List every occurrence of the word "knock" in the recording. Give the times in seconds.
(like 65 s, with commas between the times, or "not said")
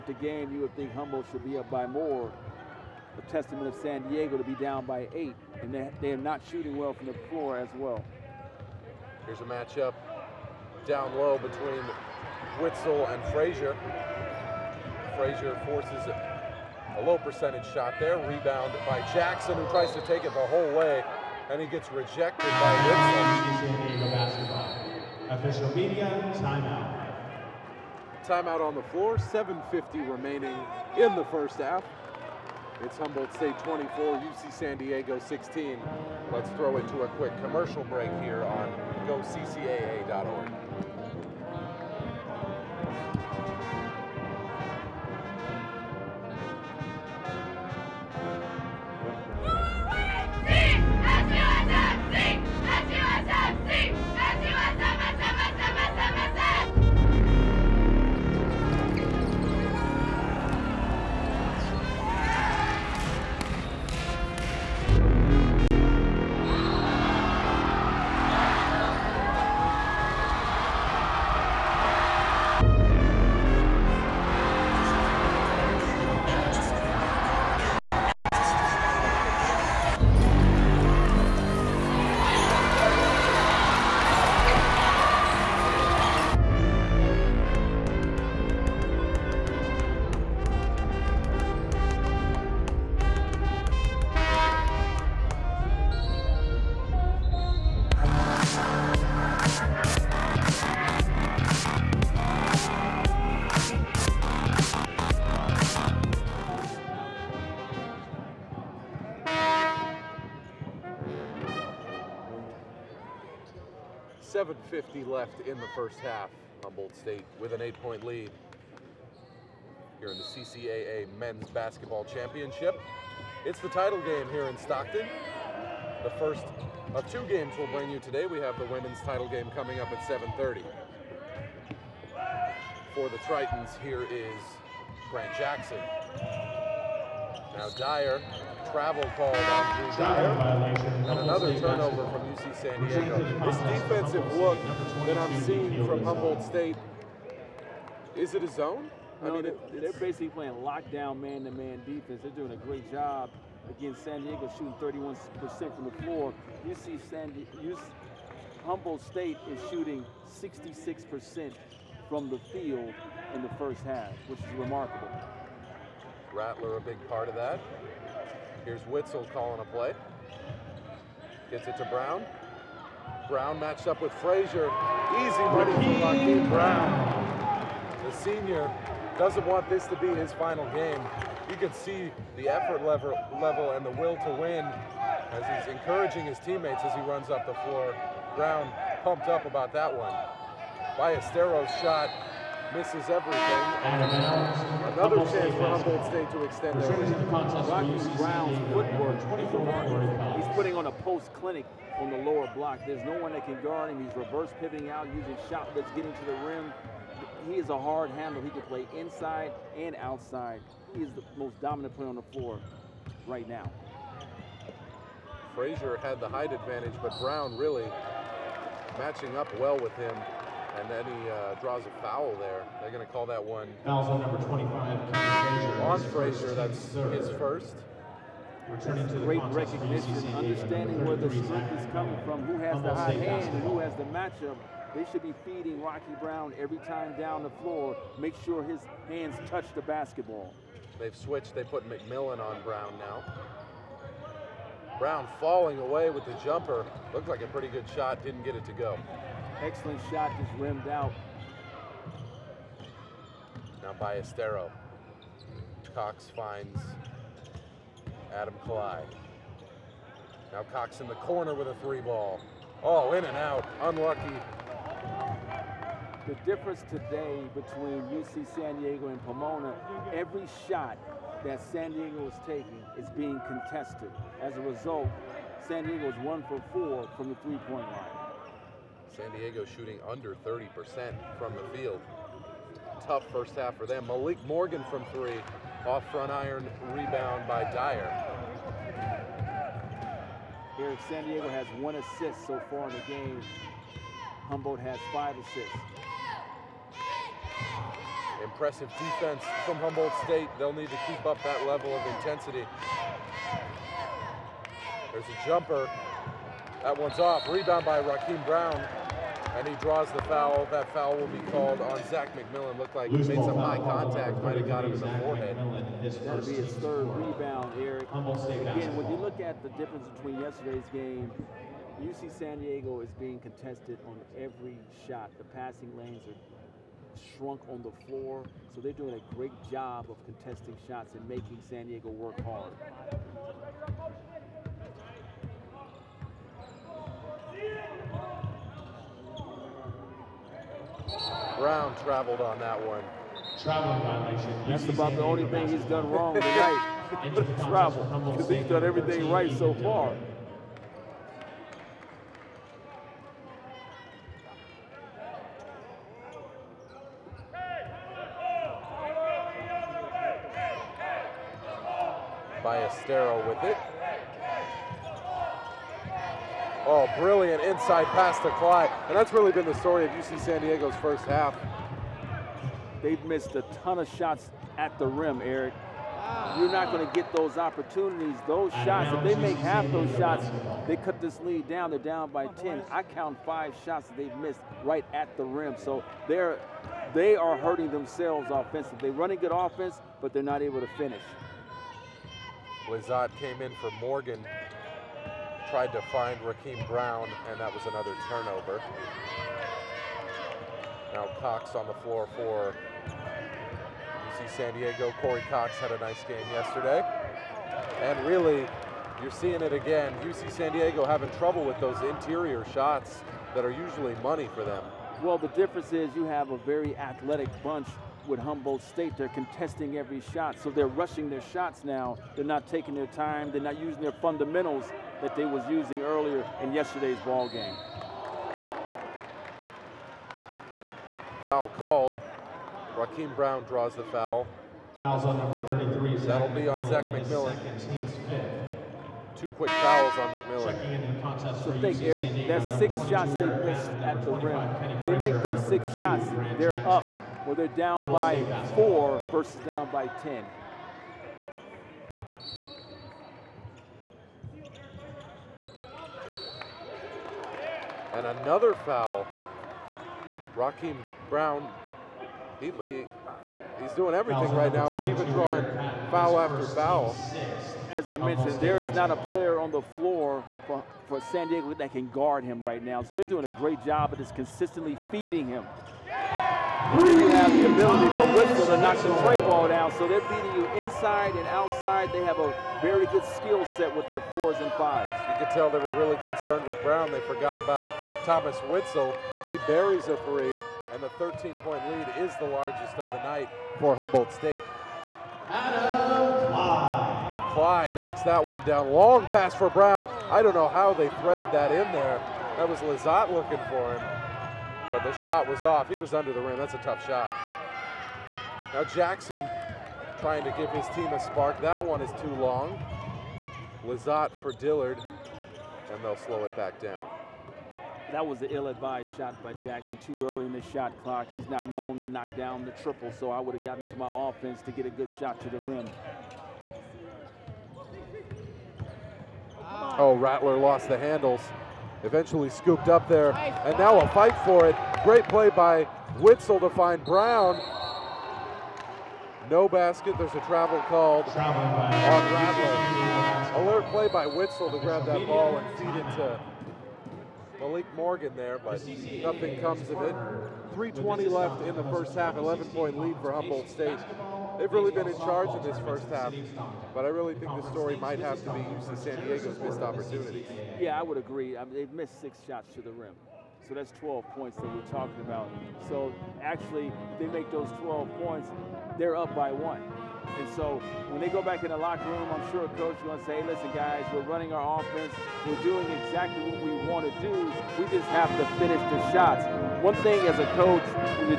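478 s, 497 s, 522 s.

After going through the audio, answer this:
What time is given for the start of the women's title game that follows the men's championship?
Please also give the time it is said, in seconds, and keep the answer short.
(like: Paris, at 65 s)
7:30, at 129 s.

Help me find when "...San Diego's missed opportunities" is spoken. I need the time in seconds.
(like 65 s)
559 s.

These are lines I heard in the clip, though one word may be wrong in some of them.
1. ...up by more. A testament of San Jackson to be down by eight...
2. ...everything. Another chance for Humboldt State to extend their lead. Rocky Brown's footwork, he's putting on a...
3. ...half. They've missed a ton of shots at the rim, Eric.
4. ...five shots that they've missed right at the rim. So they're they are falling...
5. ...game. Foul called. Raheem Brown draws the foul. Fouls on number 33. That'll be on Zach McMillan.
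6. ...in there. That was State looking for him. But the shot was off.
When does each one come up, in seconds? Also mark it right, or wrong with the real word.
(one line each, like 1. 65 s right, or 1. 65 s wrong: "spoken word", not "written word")
1. 1 s wrong: "Diego", not "Jackson"
2. 193 s right
3. 371 s right
4. 383 s wrong: "hurting", not "falling"
5. 427 s right
6. 501 s wrong: "Lazat", not "State".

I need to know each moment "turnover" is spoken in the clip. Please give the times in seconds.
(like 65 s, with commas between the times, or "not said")
141 s, 398 s.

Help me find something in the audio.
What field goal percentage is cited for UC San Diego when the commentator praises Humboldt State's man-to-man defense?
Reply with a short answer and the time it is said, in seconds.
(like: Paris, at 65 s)
31%, at 154 s.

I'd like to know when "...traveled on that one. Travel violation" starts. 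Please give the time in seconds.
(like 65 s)
342 s.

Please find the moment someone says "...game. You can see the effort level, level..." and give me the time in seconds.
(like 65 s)
180 s.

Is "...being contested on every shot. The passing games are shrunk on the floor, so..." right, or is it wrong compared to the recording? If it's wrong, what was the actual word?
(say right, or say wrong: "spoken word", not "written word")
wrong: "lanes", not "games".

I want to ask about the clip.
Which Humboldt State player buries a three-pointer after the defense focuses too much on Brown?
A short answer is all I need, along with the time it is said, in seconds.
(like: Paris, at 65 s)
Thomas Witzel, at 488 s.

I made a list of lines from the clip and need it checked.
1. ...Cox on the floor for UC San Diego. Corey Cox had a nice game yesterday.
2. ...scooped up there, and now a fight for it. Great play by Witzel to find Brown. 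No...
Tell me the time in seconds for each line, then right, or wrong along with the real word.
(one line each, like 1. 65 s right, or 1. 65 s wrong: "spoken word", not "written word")
1. 401 s right
2. 532 s right.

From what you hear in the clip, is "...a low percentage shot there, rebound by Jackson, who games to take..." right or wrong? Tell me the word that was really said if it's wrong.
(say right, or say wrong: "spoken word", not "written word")
wrong: "tries", not "games".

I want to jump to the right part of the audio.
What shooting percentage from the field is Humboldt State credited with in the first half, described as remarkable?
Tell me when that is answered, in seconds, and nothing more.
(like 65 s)
160 s.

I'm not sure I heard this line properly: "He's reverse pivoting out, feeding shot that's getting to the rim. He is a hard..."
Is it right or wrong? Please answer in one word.
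wrong.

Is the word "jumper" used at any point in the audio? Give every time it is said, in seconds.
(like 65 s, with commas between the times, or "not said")
246 s, 305 s.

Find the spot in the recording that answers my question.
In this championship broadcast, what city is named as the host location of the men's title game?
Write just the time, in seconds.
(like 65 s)
124 s.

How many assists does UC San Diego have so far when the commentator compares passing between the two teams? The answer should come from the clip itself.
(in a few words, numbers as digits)
1.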